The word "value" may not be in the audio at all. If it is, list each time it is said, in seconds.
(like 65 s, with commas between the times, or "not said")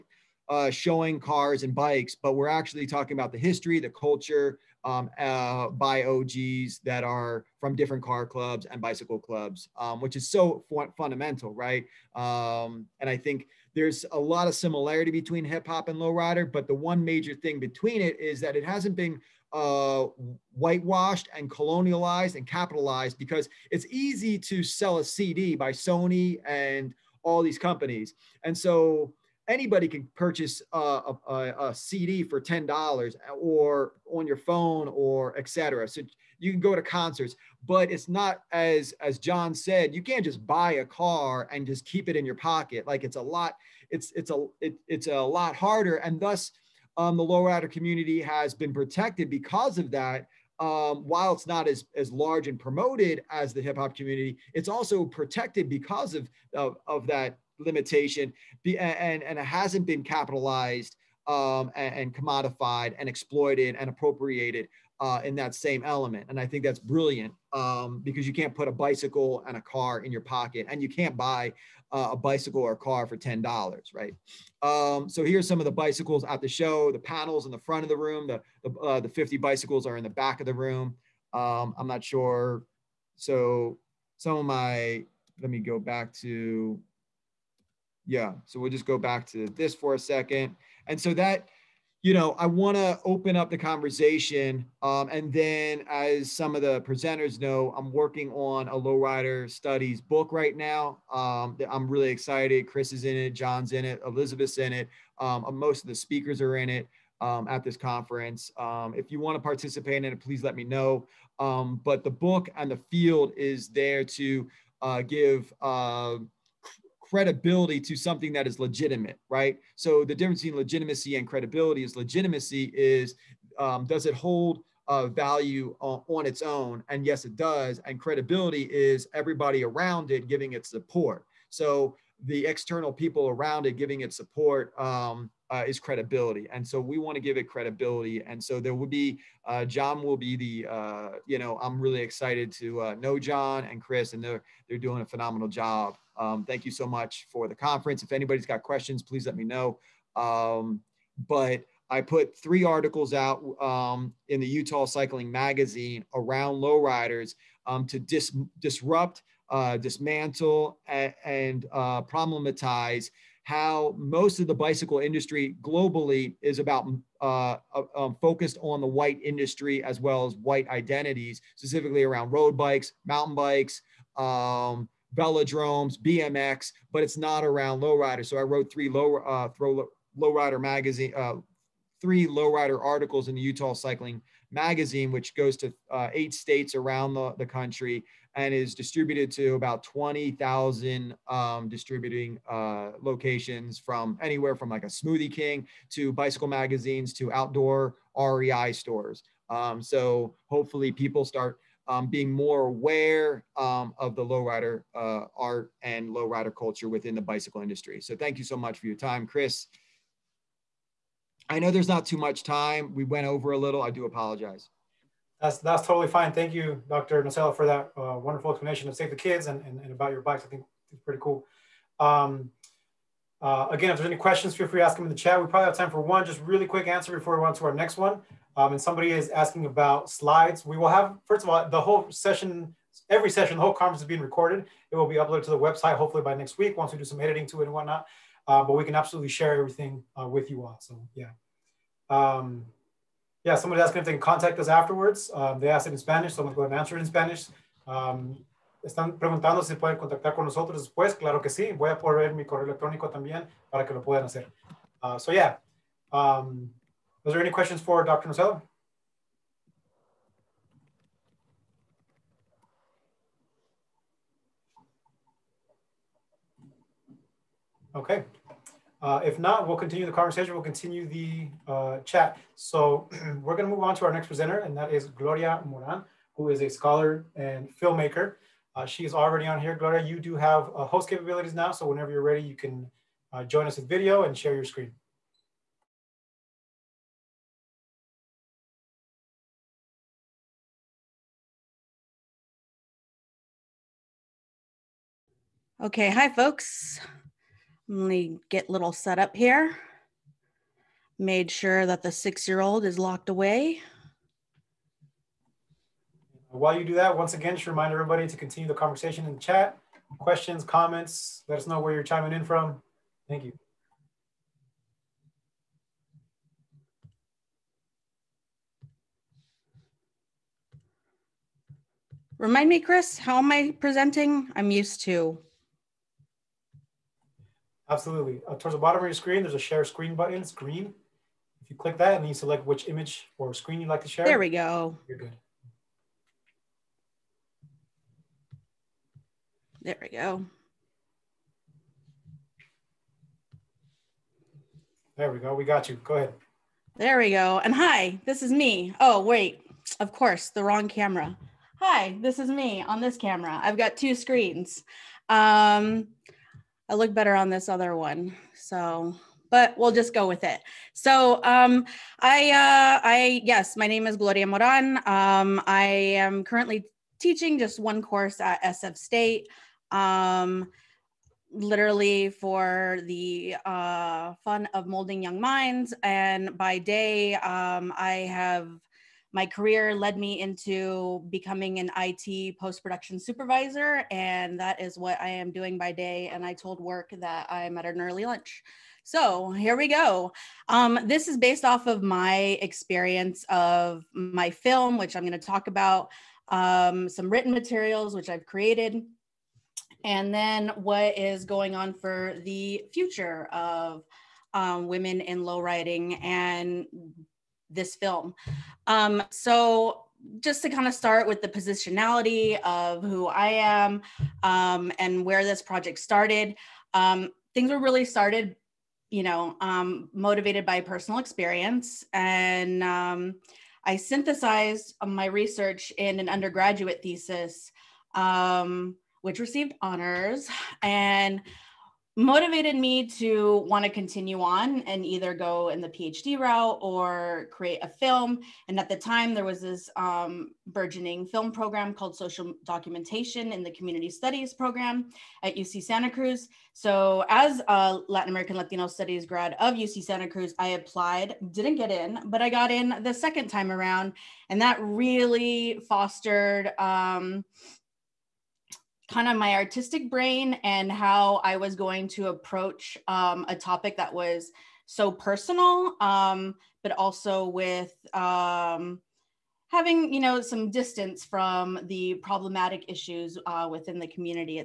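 125 s.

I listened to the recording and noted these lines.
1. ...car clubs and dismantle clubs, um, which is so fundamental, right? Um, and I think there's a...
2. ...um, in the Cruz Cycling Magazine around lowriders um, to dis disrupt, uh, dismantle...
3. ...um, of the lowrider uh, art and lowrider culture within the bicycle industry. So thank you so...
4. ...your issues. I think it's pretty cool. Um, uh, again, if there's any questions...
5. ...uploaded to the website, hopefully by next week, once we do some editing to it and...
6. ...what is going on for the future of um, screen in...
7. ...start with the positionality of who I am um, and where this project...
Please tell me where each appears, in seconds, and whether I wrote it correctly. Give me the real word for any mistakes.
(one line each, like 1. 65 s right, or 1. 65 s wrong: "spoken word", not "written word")
1. 8 s wrong: "bicycle", not "dismantle"
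2. 153 s wrong: "Utah", not "Cruz"
3. 203 s right
4. 220 s wrong: "bikes", not "issues"
5. 235 s right
6. 400 s wrong: "women", not "screen"
7. 410 s right.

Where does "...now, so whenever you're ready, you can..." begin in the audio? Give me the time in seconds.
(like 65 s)
281 s.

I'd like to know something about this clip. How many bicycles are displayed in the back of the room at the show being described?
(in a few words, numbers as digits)
50.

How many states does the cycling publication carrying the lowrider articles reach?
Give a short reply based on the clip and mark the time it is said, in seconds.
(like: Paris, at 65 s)
8, at 186 s.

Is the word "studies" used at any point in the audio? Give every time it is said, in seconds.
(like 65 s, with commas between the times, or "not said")
99 s, 444 s, 448 s.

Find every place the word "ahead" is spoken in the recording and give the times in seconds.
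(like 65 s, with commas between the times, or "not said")
246 s, 346 s.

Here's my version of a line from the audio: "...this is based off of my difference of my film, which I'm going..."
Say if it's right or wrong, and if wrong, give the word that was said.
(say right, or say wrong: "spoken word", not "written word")
wrong: "experience", not "difference".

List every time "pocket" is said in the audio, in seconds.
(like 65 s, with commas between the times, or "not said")
42 s, 70 s.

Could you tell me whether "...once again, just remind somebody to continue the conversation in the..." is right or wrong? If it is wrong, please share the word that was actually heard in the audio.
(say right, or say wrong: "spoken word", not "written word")
wrong: "everybody", not "somebody".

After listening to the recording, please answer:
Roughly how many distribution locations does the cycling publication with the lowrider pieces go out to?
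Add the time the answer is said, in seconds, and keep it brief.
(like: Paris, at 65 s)
20,000, at 189 s.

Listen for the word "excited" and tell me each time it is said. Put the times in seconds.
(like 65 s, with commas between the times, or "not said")
102 s, 141 s.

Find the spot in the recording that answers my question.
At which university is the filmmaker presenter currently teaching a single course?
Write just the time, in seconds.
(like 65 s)
368 s.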